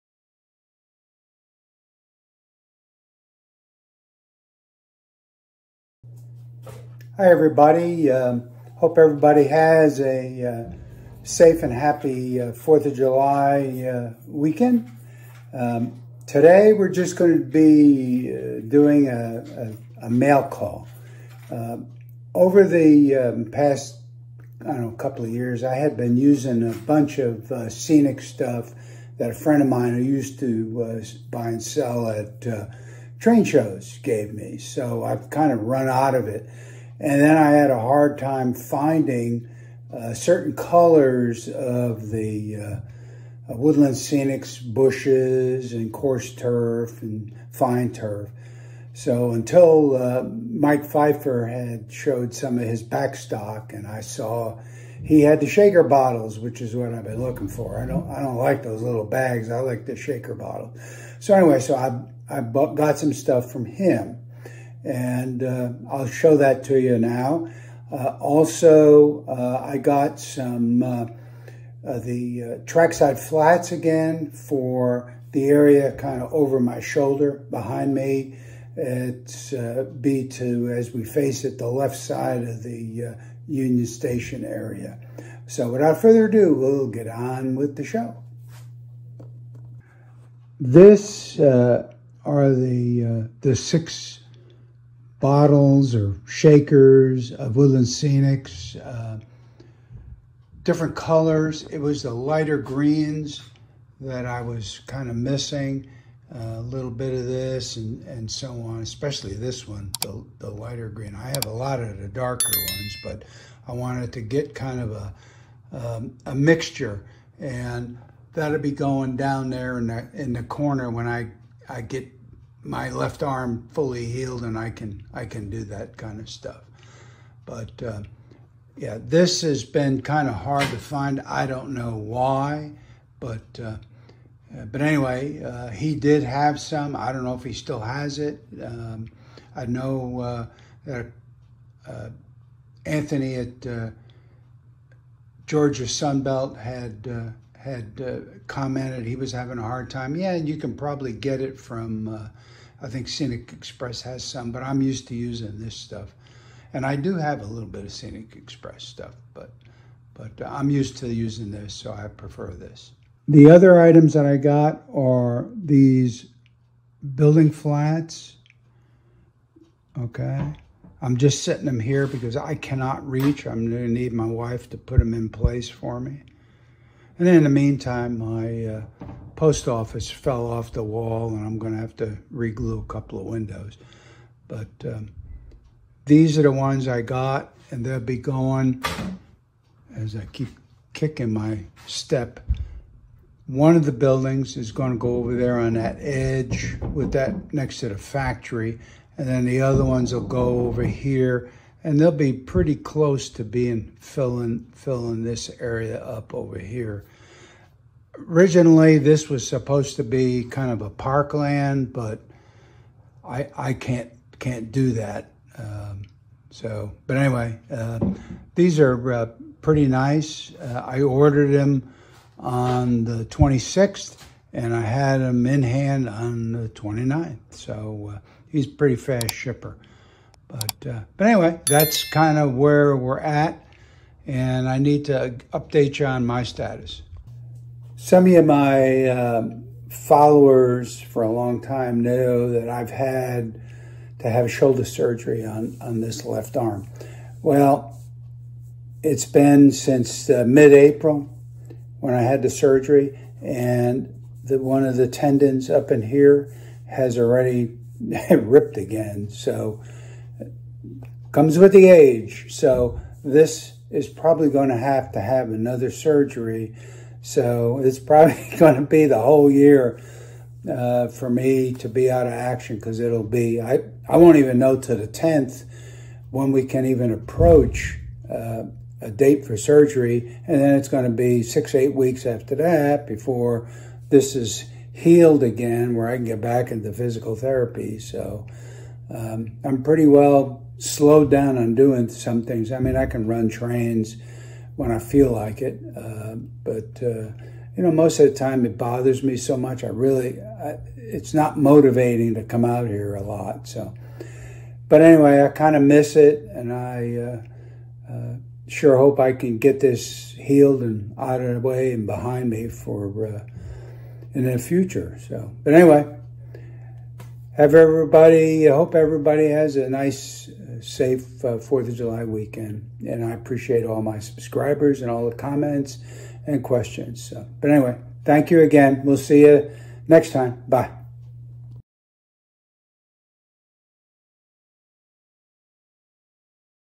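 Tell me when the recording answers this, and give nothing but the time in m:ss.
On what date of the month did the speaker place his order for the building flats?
3:43.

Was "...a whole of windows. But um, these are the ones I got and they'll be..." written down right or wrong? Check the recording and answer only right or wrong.
wrong.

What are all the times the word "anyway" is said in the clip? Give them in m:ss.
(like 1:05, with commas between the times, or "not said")
1:01, 2:14, 3:37, 3:51, 5:05, 5:15, 5:27.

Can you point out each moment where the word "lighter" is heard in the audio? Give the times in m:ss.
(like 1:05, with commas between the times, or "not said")
1:42, 1:50.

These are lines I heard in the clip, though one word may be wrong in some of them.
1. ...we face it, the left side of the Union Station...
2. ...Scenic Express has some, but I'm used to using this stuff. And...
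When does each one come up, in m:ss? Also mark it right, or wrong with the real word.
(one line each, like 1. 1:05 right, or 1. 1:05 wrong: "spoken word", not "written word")
1. 1:20 right
2. 2:33 right.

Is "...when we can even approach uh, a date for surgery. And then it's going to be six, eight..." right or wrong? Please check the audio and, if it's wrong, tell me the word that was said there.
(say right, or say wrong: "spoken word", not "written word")
right.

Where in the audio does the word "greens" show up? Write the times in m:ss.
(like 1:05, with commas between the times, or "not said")
1:42, 1:50.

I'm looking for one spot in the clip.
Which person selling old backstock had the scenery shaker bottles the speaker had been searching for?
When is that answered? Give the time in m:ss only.
0:50.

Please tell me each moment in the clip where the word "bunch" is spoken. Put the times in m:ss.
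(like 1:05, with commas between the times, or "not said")
0:26.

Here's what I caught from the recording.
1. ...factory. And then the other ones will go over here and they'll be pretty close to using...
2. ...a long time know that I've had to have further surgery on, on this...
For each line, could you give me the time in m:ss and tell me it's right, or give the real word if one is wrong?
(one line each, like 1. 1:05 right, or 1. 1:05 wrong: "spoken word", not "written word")
1. 3:17 wrong: "being", not "using"
2. 4:01 wrong: "shoulder", not "further".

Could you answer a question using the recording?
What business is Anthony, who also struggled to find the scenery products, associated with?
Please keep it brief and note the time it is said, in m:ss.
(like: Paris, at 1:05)
Georgia Sunbelt, at 2:25.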